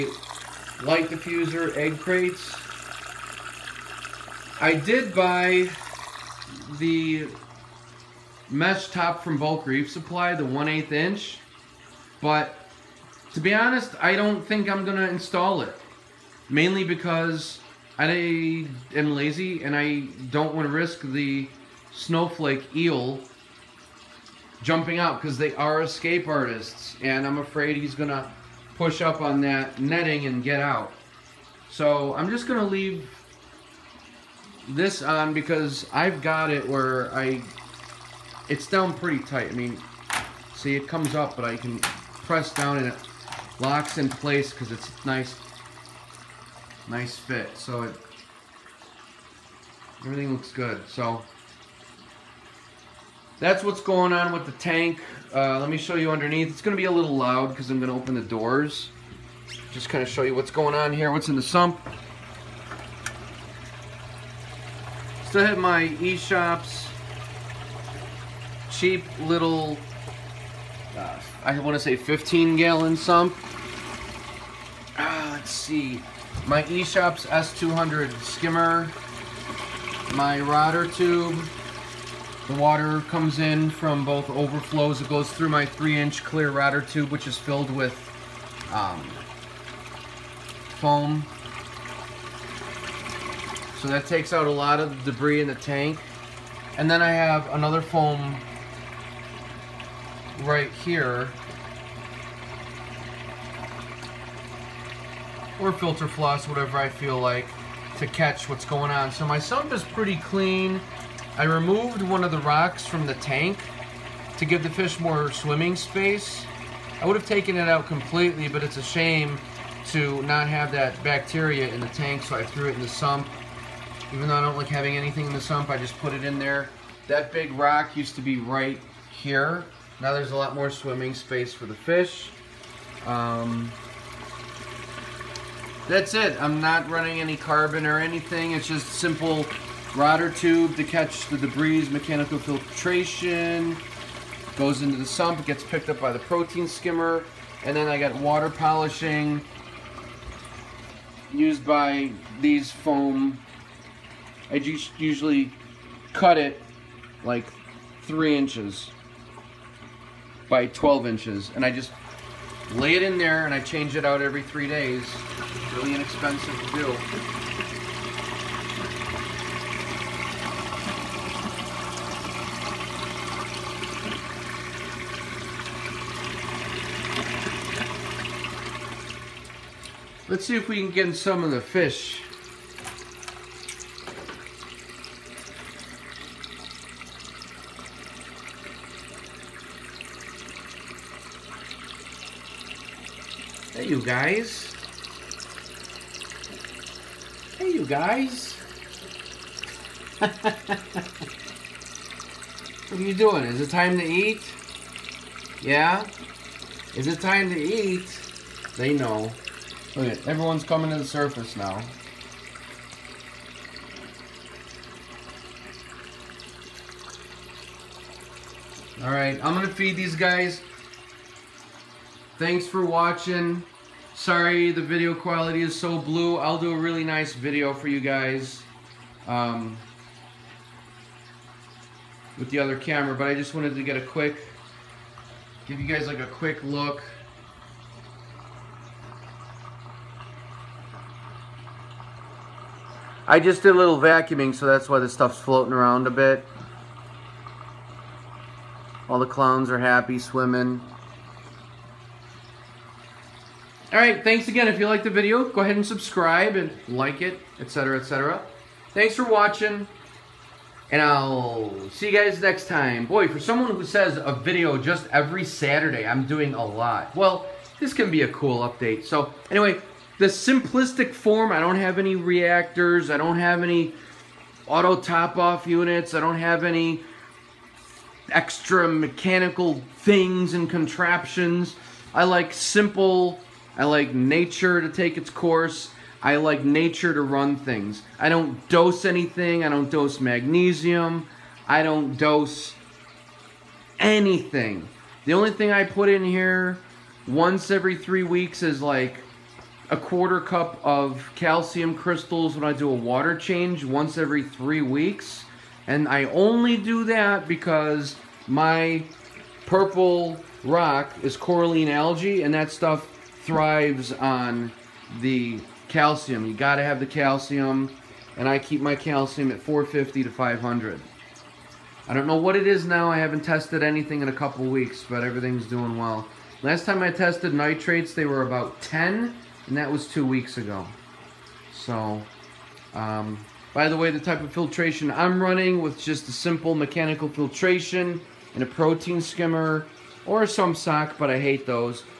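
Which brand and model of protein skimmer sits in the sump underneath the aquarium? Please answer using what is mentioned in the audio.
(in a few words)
Eshopps S200.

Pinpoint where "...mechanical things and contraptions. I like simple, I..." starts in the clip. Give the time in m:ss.
4:38.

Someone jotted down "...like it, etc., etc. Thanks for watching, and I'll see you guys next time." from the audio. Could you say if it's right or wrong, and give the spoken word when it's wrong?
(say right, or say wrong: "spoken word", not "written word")
right.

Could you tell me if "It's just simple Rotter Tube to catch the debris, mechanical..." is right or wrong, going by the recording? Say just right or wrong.
right.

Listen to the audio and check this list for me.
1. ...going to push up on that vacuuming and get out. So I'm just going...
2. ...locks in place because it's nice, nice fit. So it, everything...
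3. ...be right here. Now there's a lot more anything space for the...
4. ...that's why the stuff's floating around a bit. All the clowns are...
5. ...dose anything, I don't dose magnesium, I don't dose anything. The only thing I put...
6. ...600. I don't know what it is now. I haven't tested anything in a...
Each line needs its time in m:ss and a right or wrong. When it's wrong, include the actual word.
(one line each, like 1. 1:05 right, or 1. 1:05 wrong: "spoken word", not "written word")
1. 0:27 wrong: "netting", not "vacuuming"
2. 0:43 right
3. 2:08 wrong: "swimming", not "anything"
4. 4:04 right
5. 4:48 right
6. 5:20 wrong: "500", not "600".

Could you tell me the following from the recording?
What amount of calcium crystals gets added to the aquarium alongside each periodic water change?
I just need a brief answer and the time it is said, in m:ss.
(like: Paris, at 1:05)
a quarter cup, at 4:59.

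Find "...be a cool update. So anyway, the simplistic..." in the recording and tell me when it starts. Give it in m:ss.
4:28.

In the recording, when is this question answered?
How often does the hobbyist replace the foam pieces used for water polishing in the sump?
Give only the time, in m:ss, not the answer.
2:44.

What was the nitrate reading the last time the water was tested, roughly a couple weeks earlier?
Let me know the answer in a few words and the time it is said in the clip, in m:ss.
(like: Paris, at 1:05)
about 10, at 5:28.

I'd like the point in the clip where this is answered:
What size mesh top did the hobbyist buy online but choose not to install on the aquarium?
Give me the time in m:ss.
0:10.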